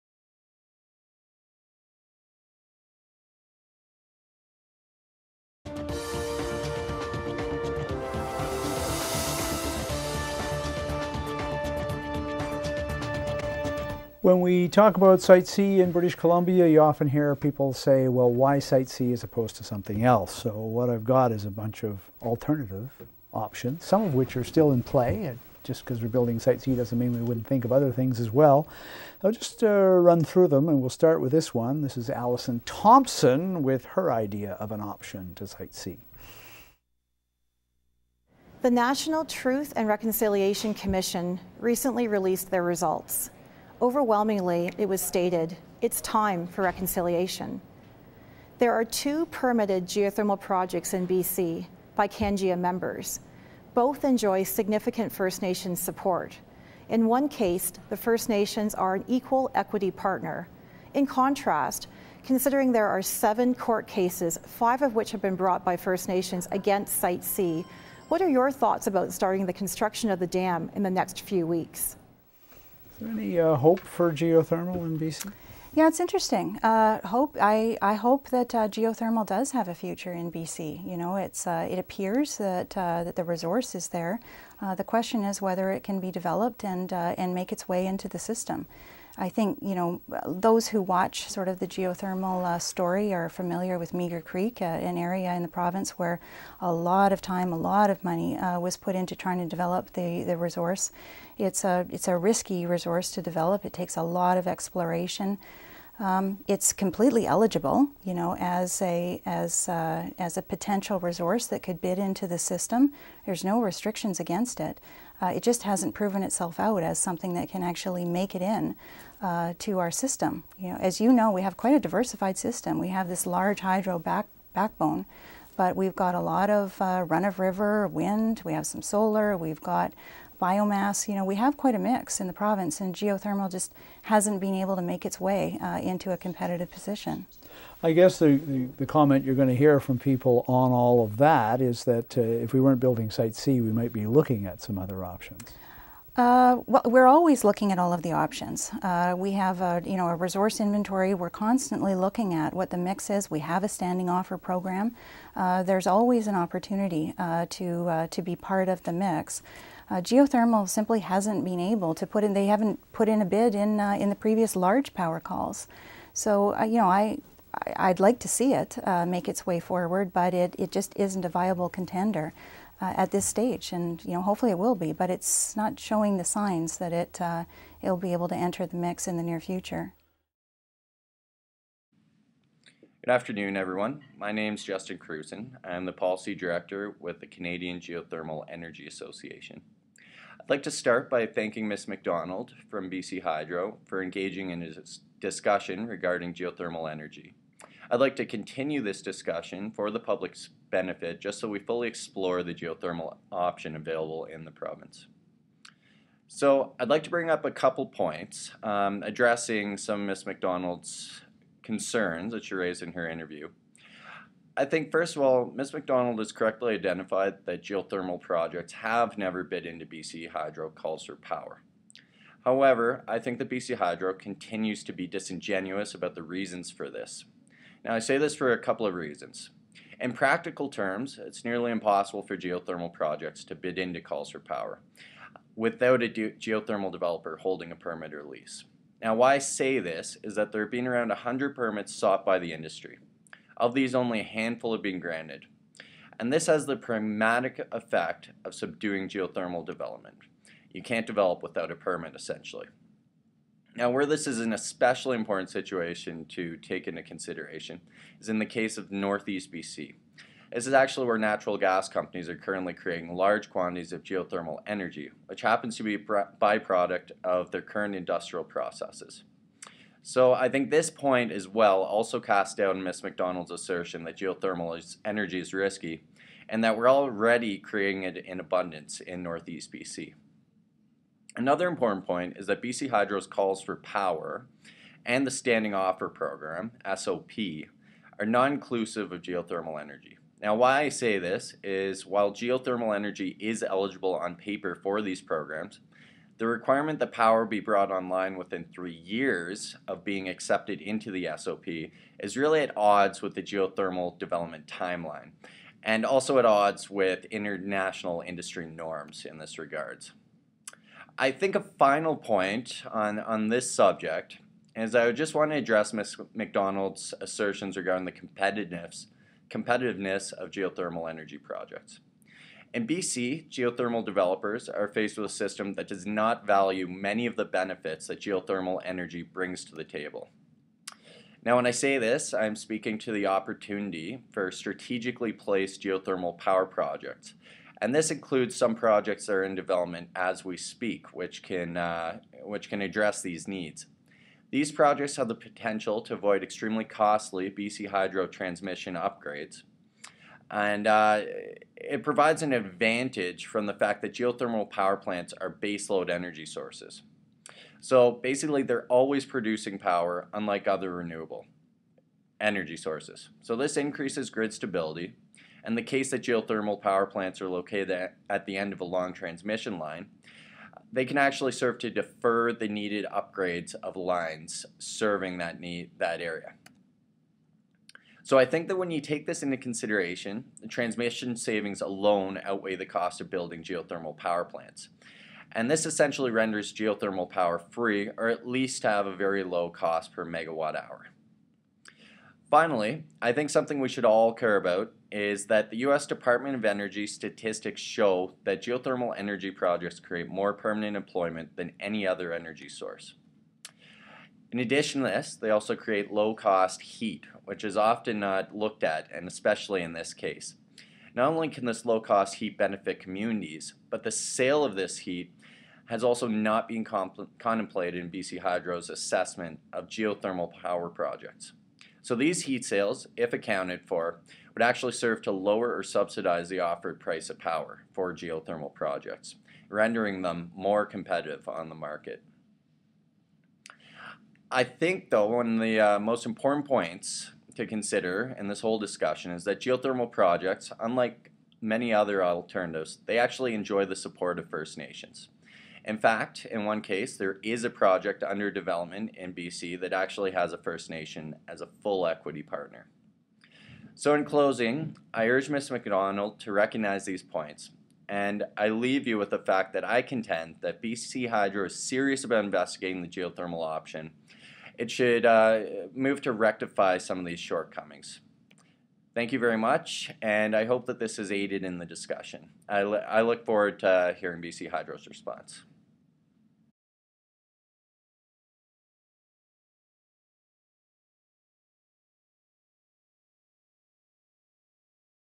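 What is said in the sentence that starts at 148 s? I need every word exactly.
Uh, we have a, you know, a resource inventory.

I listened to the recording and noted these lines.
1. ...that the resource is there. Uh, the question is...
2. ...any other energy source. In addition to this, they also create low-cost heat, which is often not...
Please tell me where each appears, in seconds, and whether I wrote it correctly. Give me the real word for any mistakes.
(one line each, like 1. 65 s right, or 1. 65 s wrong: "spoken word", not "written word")
1. 83 s right
2. 401 s right.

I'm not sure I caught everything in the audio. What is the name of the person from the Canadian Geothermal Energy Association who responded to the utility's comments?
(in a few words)
Justin Cruzen.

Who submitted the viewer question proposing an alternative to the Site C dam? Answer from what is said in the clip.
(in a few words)
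Alison Thomson.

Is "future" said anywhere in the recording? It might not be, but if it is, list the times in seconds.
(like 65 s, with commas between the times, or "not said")
79 s, 179 s.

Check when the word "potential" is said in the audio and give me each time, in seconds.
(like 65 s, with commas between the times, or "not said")
110 s, 345 s.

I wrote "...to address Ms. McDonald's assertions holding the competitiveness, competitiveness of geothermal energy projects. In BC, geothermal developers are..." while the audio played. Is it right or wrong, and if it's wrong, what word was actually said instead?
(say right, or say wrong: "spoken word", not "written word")
wrong: "regarding", not "holding".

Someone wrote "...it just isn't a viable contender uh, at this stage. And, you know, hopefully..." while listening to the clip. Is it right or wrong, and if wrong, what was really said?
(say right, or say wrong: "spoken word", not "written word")
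right.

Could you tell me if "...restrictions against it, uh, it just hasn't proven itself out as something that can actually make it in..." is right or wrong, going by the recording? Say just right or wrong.
right.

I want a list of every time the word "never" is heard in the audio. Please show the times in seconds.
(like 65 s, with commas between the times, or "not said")
219 s.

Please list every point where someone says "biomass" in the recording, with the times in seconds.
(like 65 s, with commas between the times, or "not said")
130 s.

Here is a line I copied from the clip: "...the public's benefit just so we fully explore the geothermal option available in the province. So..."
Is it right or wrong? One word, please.
right.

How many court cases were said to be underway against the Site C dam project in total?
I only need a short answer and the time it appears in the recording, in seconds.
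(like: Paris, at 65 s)
7, at 63 s.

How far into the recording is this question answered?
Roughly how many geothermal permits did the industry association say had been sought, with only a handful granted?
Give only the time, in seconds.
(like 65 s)
240 s.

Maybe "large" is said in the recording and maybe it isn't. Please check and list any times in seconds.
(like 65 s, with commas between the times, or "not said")
123 s, 164 s, 263 s.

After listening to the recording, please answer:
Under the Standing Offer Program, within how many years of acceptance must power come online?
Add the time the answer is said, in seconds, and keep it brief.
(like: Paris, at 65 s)
3, at 298 s.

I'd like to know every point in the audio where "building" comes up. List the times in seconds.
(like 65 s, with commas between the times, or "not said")
26 s, 142 s, 383 s.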